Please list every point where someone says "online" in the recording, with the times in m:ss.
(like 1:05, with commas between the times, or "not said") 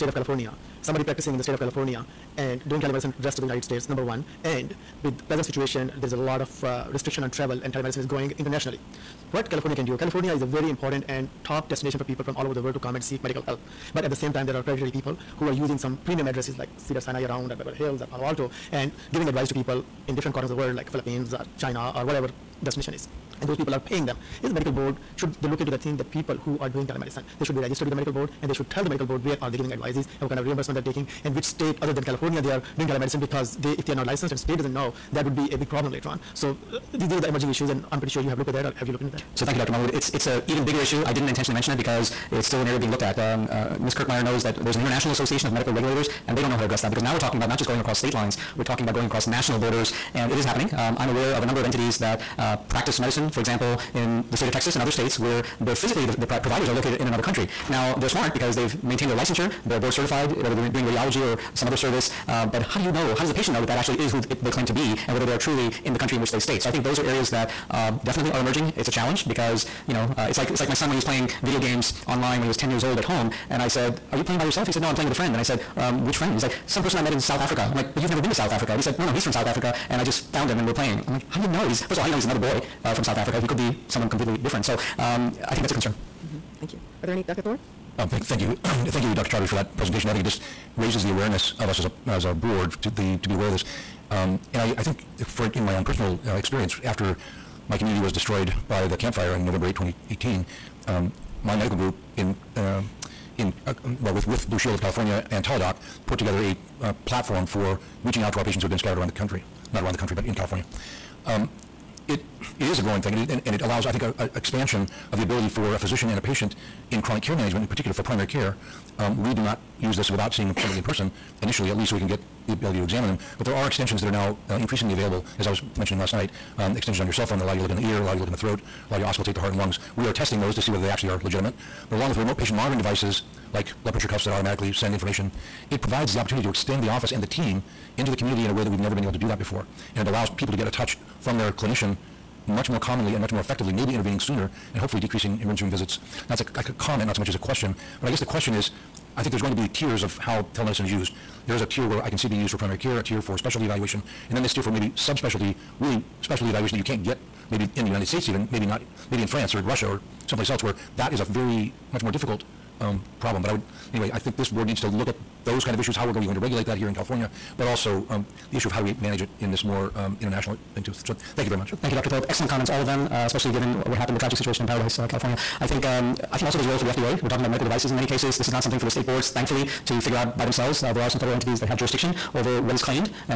1:12.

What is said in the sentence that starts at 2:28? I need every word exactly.
But I guess the question is, I think there's going to be tiers of how telemedicine is used.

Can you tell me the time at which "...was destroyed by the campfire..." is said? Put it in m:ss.
1:38.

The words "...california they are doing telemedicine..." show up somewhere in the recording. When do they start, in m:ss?
0:32.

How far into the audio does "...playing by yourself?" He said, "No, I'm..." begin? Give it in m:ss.
1:14.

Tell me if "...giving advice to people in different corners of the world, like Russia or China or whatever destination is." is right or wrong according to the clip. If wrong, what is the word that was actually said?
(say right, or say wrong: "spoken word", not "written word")
wrong: "Philippines", not "Russia".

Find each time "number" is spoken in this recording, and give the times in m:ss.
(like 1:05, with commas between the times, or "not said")
0:03, 0:51.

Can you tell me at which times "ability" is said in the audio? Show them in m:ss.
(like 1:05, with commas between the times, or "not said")
1:55, 2:02.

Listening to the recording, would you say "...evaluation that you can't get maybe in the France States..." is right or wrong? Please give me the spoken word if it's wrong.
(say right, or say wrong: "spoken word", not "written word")
wrong: "United", not "France".